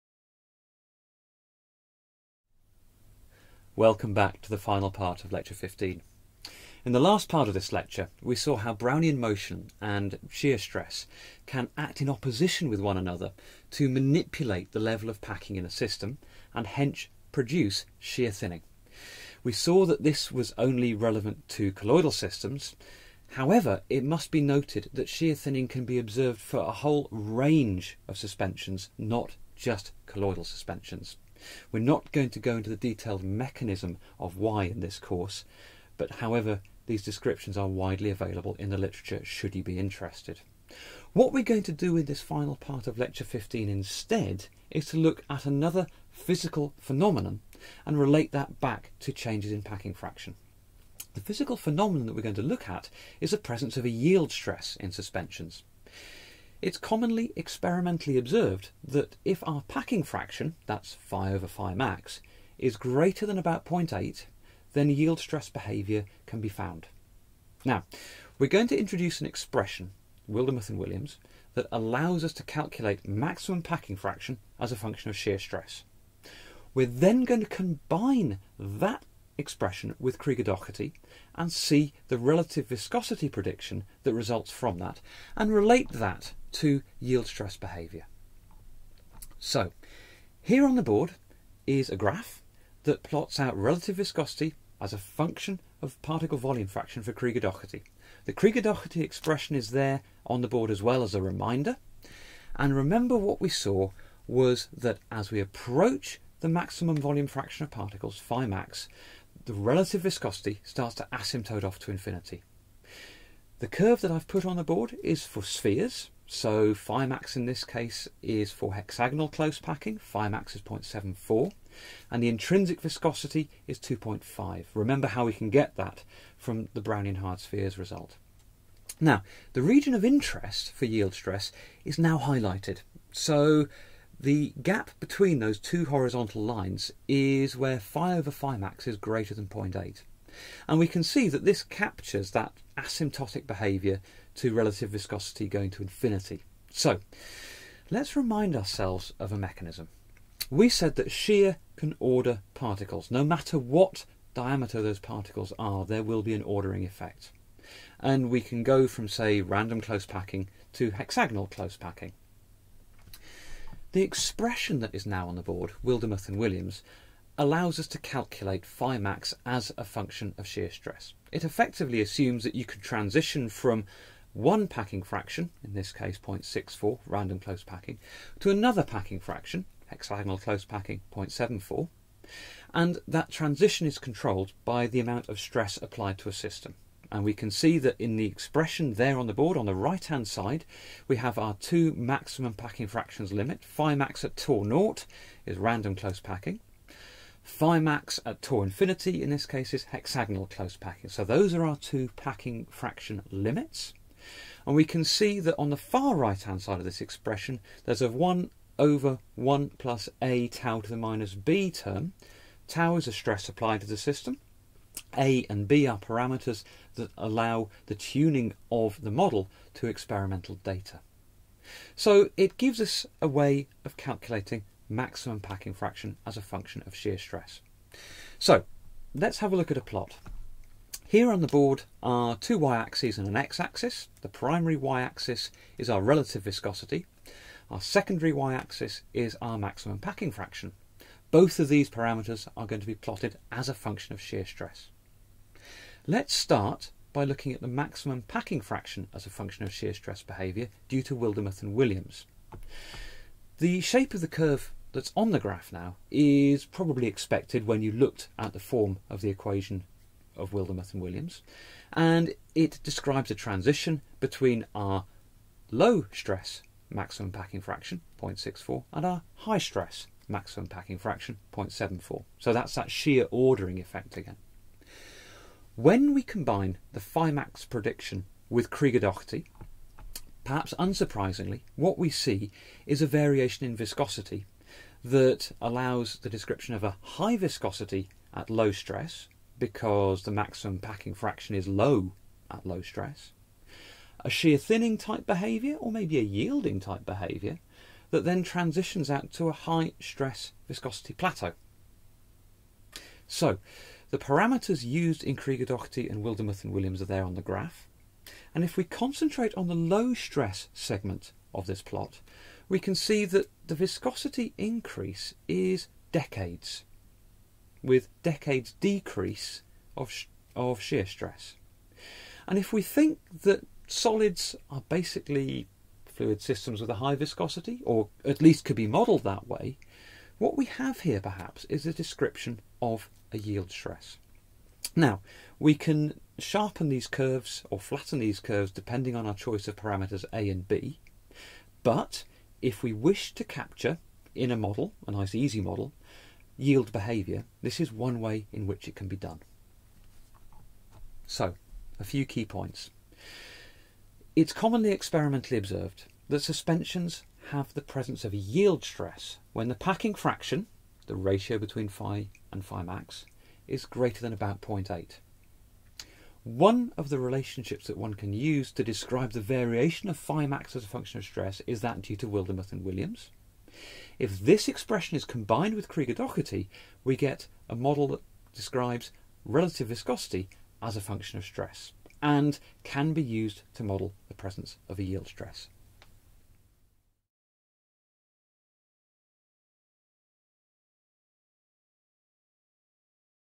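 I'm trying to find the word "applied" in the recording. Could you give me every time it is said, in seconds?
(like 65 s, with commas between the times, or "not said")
185 s, 213 s.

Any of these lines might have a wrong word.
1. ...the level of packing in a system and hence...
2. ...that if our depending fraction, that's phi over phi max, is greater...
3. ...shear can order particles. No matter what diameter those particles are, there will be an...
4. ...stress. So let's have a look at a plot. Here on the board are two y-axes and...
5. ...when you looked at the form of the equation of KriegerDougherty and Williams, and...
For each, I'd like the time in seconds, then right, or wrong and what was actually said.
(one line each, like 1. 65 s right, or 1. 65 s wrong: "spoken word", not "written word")
1. 14 s right
2. 58 s wrong: "packing", not "depending"
3. 151 s right
4. 227 s right
5. 257 s wrong: "Wildemuth", not "KriegerDougherty".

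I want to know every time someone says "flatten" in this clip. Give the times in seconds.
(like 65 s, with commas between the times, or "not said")
337 s.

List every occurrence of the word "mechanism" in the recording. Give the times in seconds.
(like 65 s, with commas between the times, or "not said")
33 s, 149 s.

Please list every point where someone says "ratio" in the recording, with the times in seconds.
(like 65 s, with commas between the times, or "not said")
361 s.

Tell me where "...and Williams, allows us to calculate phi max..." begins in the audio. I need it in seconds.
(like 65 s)
166 s.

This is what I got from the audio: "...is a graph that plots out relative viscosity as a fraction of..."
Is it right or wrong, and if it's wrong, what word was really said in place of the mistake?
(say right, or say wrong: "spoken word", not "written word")
wrong: "function", not "fraction".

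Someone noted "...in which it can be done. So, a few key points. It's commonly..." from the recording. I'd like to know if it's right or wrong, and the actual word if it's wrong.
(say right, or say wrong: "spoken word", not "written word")
right.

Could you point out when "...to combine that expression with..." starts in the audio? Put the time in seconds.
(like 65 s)
77 s.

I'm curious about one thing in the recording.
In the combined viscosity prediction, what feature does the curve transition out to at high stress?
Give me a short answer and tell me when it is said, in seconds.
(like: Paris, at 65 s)
high stress viscosity plateau, at 299 s.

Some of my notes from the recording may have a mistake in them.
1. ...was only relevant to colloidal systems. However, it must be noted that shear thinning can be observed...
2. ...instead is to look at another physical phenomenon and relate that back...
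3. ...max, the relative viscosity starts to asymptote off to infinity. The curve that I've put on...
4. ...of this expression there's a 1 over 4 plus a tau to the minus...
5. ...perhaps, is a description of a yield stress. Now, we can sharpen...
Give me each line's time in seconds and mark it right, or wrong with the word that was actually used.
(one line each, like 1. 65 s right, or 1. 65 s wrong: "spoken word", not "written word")
1. 20 s right
2. 43 s right
3. 108 s right
4. 206 s wrong: "1", not "4"
5. 331 s right.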